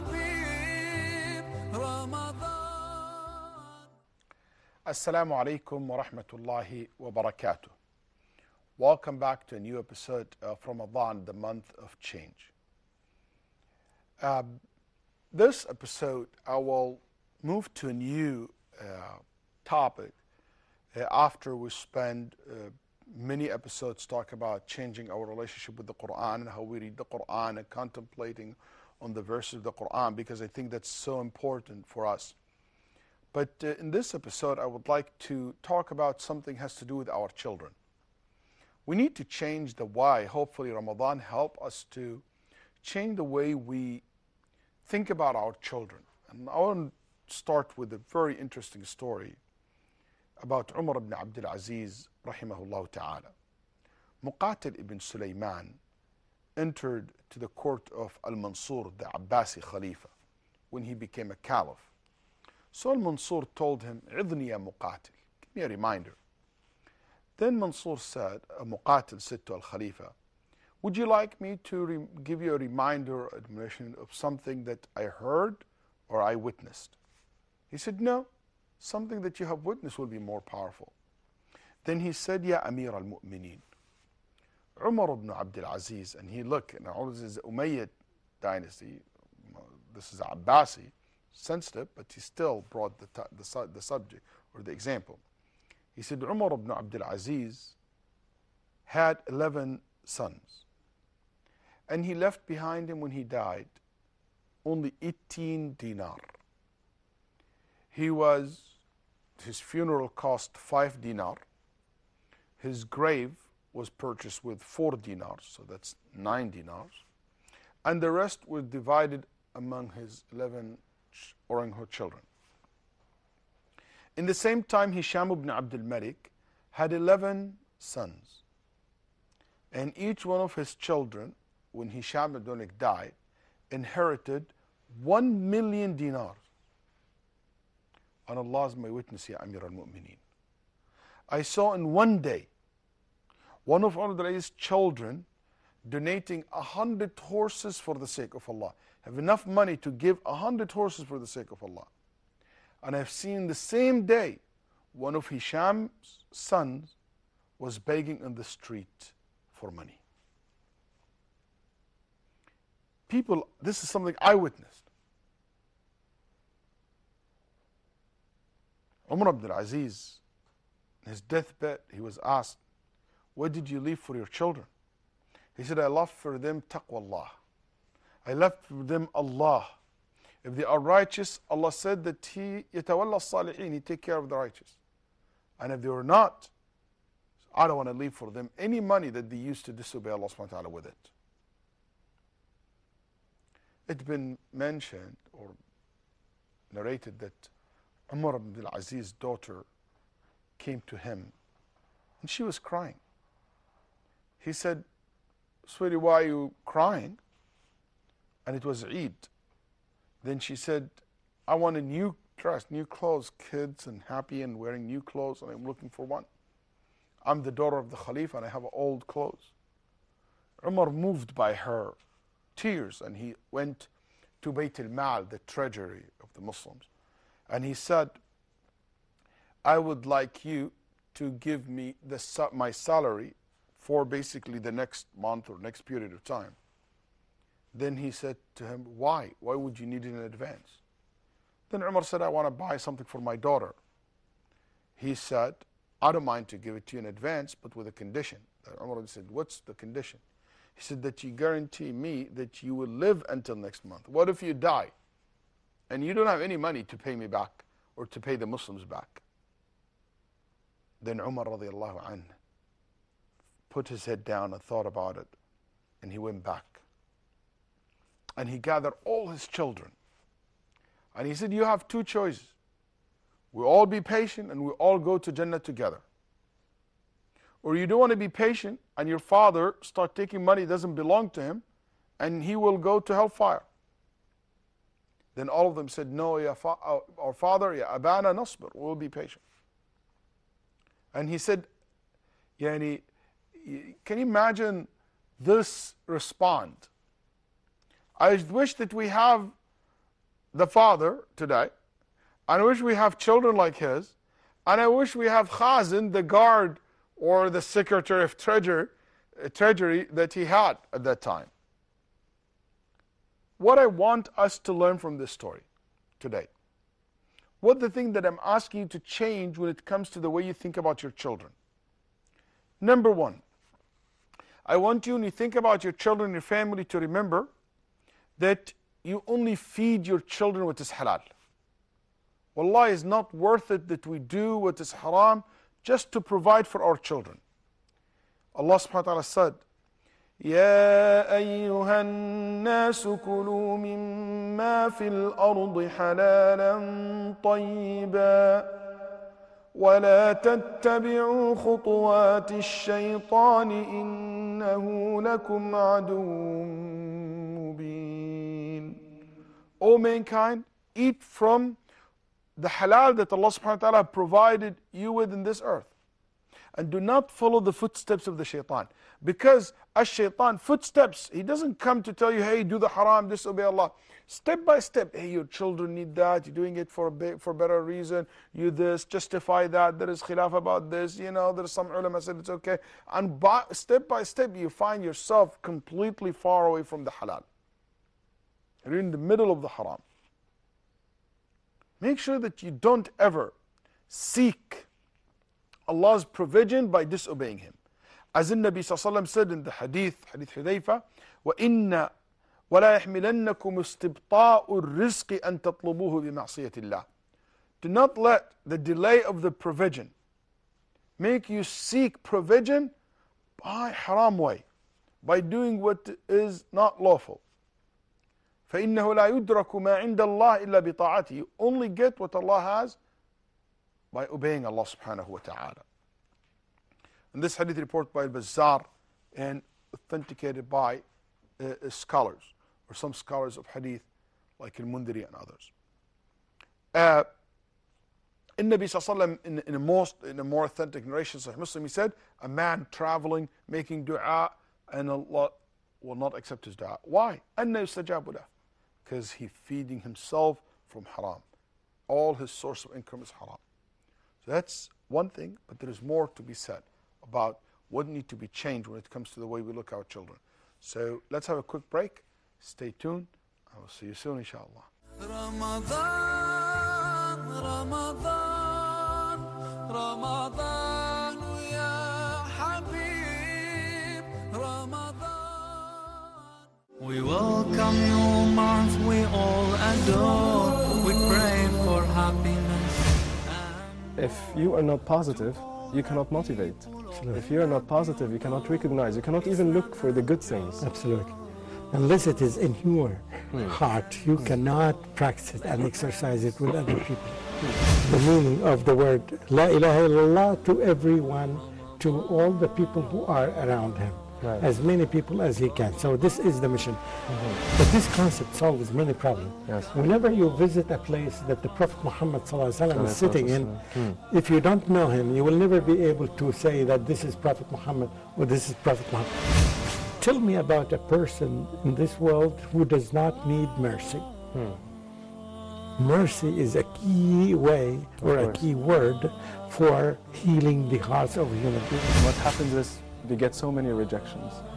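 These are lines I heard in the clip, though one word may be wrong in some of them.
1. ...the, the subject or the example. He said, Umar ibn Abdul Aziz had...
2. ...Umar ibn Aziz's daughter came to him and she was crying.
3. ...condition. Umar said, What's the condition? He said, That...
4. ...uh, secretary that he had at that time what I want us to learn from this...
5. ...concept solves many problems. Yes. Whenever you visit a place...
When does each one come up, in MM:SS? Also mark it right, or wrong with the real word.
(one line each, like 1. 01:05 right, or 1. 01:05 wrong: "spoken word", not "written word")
1. 01:33 right
2. 03:18 right
3. 04:07 right
4. 05:09 wrong: "treasury", not "secretary"
5. 08:28 right.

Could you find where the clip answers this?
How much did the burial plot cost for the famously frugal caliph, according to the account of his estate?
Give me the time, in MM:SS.
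01:54.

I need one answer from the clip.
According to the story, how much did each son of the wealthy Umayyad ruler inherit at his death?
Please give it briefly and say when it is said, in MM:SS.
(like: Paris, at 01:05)
1 million dinars, at 02:15.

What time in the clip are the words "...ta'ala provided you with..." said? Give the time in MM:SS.
06:03.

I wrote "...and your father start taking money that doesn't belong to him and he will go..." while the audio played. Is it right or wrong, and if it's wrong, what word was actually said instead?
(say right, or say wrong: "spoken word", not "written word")
right.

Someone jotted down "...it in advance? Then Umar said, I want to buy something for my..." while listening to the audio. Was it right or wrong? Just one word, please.
right.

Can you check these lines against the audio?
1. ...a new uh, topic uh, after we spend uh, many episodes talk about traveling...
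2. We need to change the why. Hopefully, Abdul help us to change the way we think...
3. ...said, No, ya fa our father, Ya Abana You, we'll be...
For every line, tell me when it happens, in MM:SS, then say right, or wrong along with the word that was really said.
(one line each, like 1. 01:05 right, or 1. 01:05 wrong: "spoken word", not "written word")
1. 00:17 wrong: "changing", not "traveling"
2. 00:38 wrong: "Ramadan", not "Abdul"
3. 04:45 wrong: "Nasbir", not "You".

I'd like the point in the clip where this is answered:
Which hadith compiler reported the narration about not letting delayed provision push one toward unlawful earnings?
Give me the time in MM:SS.
07:08.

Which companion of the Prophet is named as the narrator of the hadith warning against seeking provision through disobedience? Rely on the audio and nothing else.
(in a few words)
Hudayfa.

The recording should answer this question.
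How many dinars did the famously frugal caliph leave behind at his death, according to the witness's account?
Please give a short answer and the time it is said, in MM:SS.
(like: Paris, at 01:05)
18, at 01:44.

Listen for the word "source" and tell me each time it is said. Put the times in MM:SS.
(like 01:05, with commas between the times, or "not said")
07:32.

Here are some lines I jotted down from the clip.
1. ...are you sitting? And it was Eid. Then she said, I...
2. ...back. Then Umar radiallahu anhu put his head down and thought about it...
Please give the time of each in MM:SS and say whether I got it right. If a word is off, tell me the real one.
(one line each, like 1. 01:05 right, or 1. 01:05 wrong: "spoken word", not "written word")
1. 03:26 wrong: "crying", not "sitting"
2. 04:18 right.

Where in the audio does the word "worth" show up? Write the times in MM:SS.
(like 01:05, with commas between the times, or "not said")
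05:33.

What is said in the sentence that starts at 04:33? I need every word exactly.
We all be patient and we all go to Jannah together.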